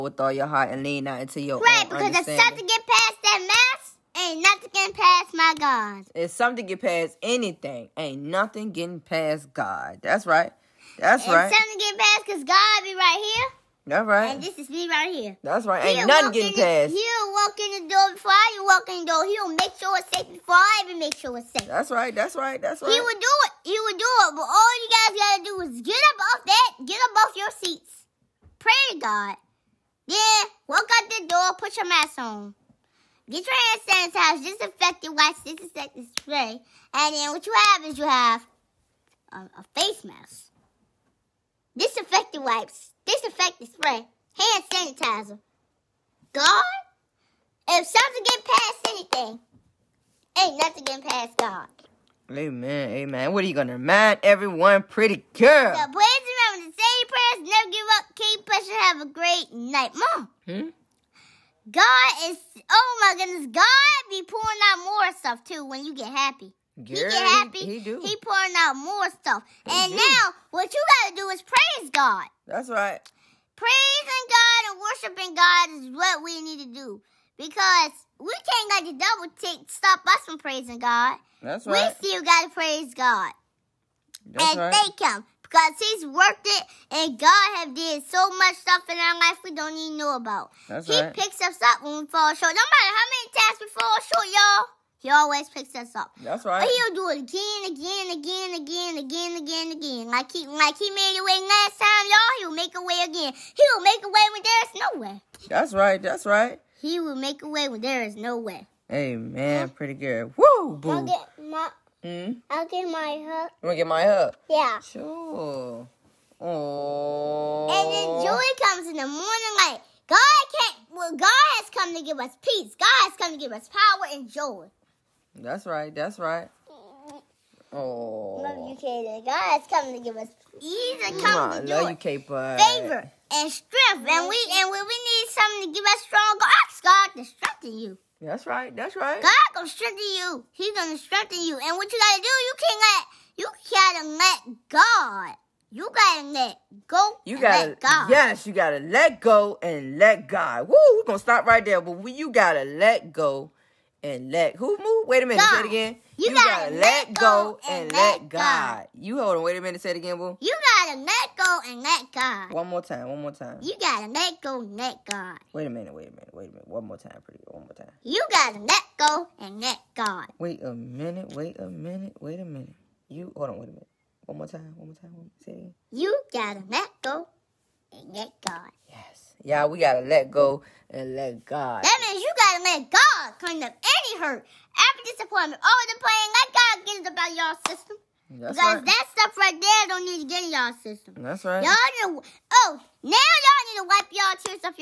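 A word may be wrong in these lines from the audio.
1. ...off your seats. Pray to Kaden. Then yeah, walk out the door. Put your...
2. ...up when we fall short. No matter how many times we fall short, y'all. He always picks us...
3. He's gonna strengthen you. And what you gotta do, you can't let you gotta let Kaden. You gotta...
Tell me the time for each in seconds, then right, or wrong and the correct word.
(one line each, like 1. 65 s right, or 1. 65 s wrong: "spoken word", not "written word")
1. 27 s wrong: "God", not "Kaden"
2. 91 s right
3. 140 s wrong: "God", not "Kaden".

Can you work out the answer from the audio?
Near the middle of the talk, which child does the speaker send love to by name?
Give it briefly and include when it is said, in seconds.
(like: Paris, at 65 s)
Kaden, at 128 s.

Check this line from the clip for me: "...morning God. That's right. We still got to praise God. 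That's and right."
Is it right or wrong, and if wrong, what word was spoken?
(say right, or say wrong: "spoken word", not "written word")
wrong: "praising", not "morning".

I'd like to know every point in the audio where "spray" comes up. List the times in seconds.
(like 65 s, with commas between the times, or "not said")
36 s, 43 s.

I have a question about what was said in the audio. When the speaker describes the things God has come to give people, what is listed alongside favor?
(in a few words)
strength.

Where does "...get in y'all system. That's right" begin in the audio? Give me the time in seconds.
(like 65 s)
190 s.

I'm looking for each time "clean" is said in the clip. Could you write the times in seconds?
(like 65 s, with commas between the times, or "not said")
183 s.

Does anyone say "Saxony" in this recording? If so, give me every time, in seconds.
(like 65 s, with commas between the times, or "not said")
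not said.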